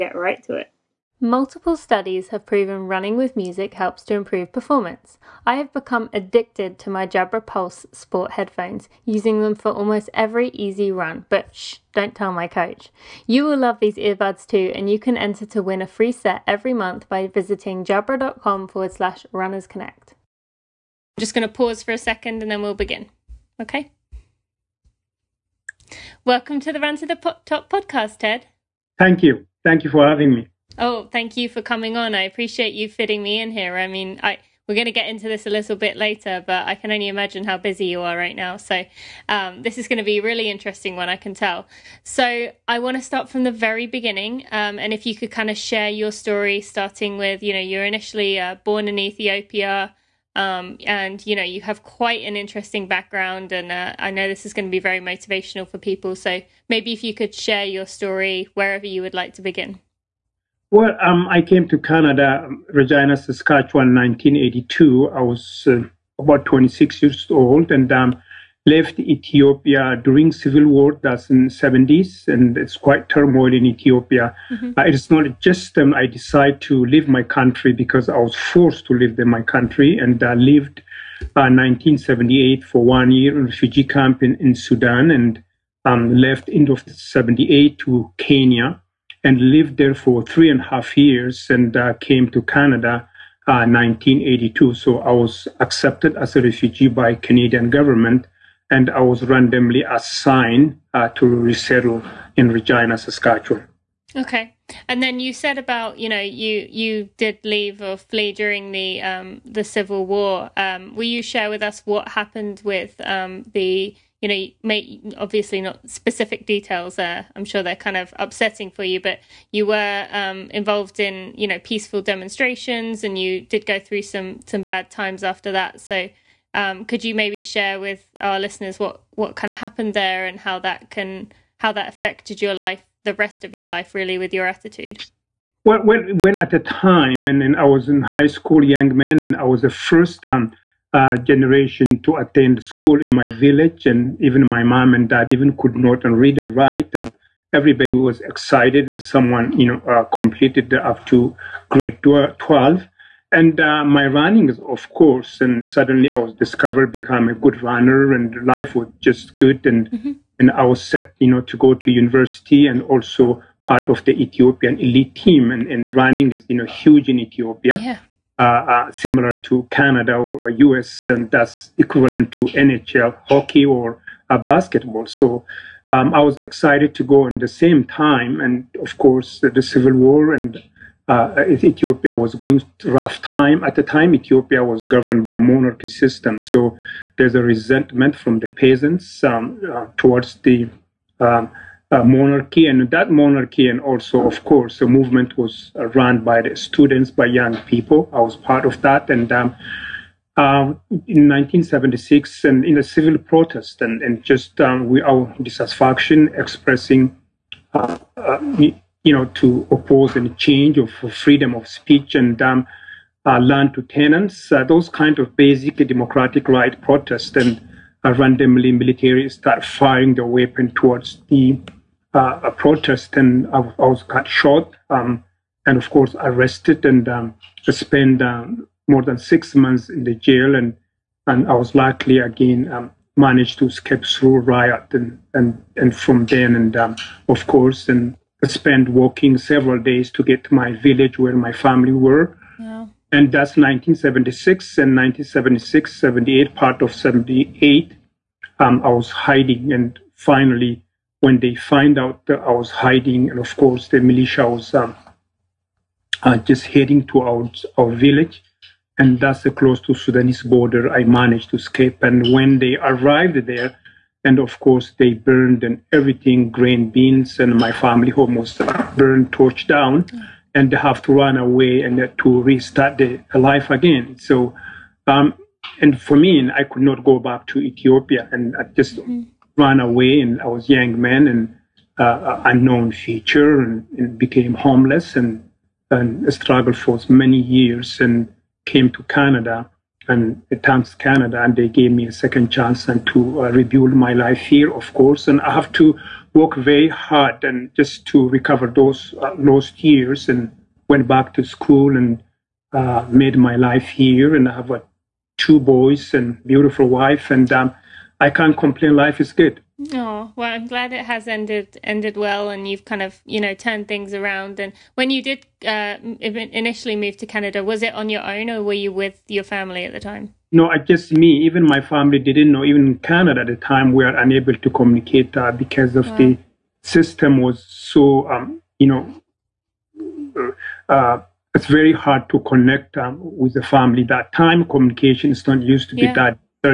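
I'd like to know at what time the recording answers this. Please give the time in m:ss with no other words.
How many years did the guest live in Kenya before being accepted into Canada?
1:30.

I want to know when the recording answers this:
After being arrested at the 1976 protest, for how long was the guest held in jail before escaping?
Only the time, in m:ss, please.
3:48.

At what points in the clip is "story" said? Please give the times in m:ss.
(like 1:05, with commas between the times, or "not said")
0:46, 0:57.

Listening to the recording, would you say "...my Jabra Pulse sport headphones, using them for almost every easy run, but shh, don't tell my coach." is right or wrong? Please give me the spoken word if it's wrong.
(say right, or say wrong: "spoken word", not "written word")
right.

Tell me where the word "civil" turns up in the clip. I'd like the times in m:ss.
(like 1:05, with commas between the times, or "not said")
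1:10, 1:49, 2:59, 3:22.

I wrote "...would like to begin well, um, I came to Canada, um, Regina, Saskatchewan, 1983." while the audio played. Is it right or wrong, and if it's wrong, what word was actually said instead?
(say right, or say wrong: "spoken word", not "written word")
wrong: "1982", not "1983".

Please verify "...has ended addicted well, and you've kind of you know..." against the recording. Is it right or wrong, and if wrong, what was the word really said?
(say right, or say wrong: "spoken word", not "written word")
wrong: "ended", not "addicted".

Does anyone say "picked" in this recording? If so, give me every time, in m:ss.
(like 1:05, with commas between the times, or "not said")
not said.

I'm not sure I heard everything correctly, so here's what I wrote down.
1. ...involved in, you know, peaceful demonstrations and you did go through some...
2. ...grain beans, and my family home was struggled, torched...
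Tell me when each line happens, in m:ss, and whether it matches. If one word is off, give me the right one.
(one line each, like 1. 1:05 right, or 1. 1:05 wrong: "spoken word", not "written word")
1. 2:00 right
2. 4:26 wrong: "burned", not "struggled".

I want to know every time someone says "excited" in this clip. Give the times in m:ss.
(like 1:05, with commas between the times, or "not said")
2:28, 2:56.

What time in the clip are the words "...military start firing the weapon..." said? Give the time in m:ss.
3:38.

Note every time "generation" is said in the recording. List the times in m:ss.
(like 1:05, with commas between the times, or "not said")
2:21.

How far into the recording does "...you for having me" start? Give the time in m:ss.
0:29.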